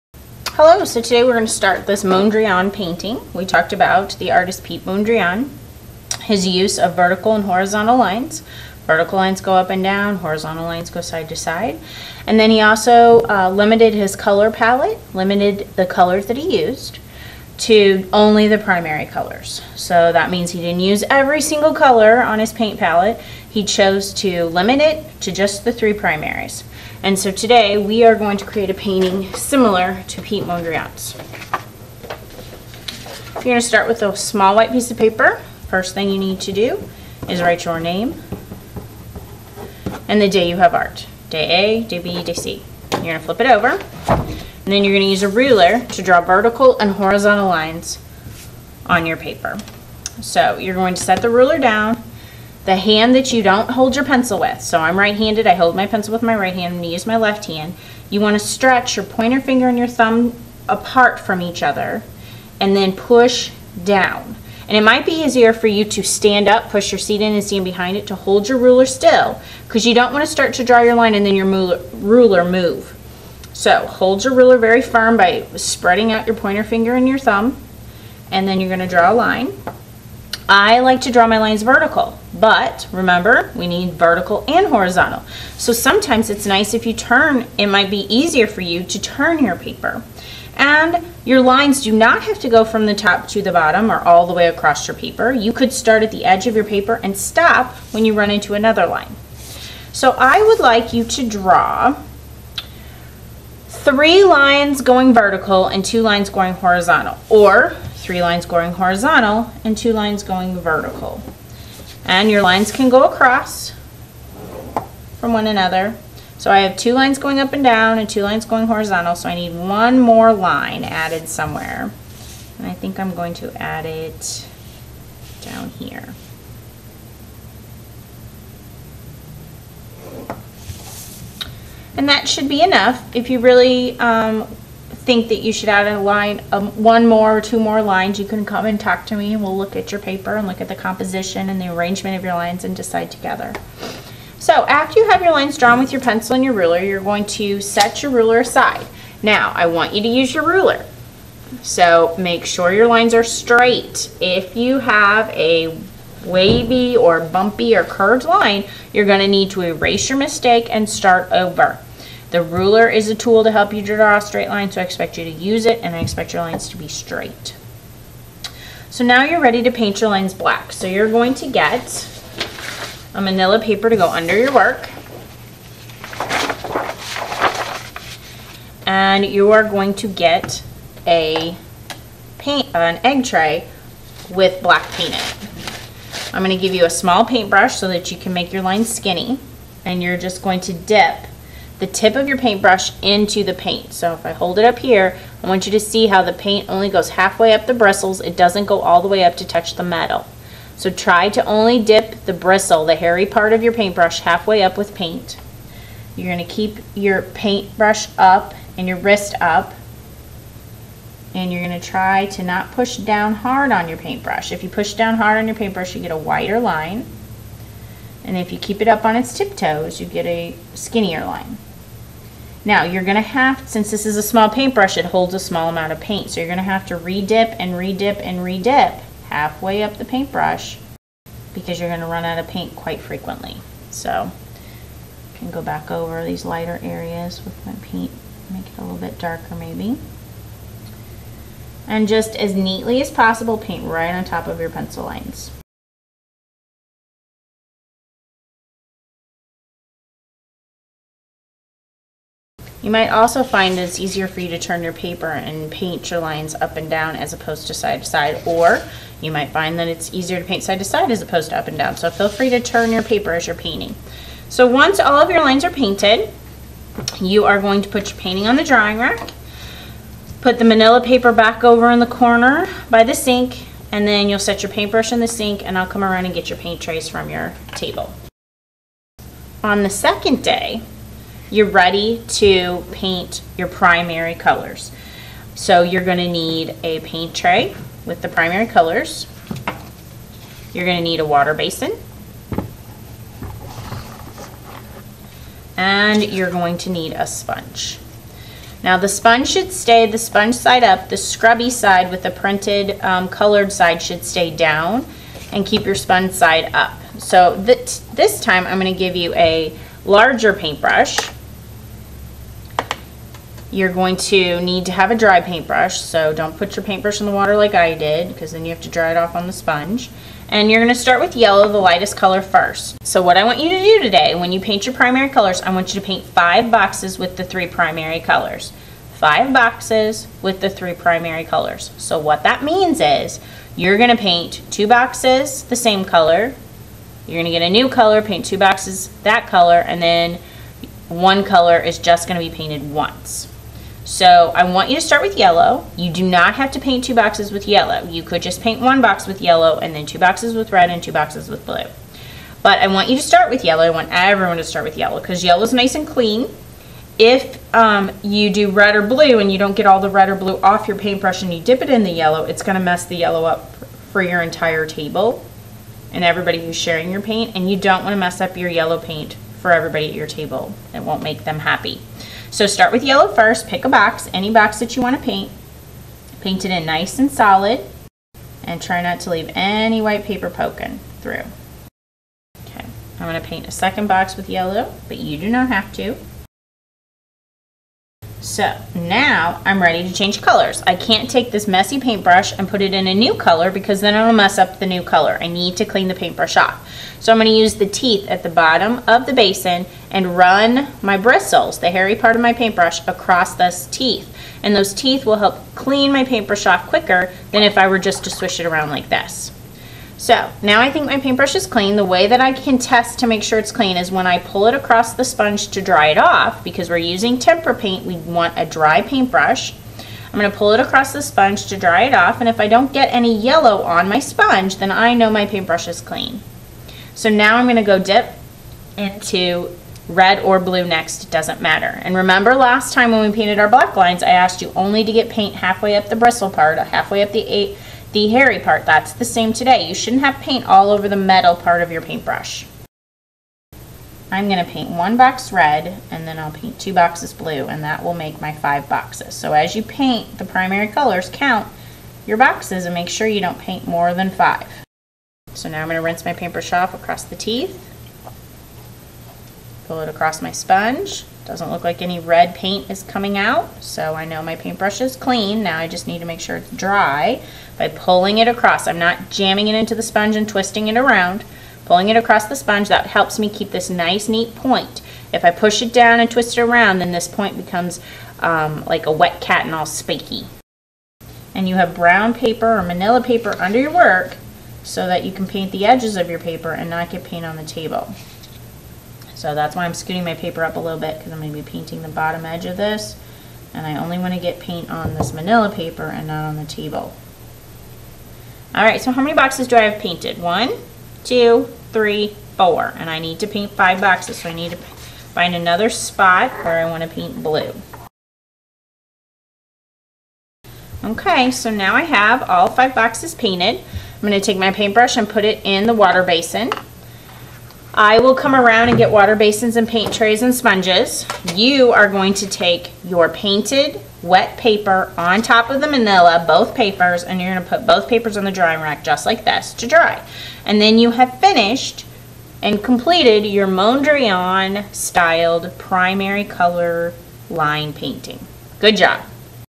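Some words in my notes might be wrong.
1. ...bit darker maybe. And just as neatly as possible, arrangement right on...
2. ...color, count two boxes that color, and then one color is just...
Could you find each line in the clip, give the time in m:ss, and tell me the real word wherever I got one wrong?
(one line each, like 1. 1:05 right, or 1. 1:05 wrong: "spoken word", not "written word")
1. 3:58 wrong: "paint", not "arrangement"
2. 5:37 wrong: "paint", not "count".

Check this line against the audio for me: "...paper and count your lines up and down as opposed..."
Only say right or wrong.
wrong.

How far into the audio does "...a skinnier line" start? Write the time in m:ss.
3:40.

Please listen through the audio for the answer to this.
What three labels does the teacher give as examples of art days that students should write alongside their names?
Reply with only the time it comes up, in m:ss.
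0:41.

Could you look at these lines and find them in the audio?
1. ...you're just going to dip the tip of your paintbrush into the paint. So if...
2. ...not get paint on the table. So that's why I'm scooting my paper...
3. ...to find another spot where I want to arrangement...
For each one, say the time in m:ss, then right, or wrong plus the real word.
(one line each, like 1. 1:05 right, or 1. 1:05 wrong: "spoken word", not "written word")
1. 3:10 right
2. 8:06 right
3. 8:24 wrong: "paint", not "arrangement".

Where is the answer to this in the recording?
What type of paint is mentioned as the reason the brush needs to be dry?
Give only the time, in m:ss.
6:57.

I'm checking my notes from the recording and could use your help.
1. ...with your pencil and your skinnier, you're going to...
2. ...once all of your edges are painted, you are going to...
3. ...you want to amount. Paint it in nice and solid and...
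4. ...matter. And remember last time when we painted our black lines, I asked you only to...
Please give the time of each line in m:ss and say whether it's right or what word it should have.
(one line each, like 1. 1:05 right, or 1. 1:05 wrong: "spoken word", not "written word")
1. 2:25 wrong: "ruler", not "skinnier"
2. 4:24 wrong: "lines", not "edges"
3. 6:14 wrong: "paint", not "amount"
4. 7:11 right.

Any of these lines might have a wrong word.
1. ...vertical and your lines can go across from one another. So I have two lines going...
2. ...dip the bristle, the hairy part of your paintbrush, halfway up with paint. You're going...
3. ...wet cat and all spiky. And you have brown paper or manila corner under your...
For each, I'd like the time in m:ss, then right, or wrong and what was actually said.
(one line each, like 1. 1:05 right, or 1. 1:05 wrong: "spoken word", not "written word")
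1. 1:50 right
2. 3:21 right
3. 7:59 wrong: "paper", not "corner".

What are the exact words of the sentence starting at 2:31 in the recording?
So make sure your lines are straight.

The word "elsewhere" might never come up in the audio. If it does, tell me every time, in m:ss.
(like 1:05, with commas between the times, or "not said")
not said.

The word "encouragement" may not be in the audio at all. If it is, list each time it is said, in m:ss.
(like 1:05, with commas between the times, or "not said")
not said.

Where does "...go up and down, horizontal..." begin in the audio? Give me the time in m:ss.
0:09.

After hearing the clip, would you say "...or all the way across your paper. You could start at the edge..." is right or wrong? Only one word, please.
right.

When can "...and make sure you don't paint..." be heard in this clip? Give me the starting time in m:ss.
7:32.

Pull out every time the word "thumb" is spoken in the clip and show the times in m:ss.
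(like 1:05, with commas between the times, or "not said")
0:59, 1:17.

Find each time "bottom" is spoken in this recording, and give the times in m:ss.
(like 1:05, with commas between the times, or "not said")
1:33, 6:38, 8:12.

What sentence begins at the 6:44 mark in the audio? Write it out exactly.
And those teeth will help clean my paintbrush off quicker than if I were just to swish it around like this.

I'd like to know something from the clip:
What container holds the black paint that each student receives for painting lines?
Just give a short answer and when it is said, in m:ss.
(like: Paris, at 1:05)
An egg tray, at 3:03.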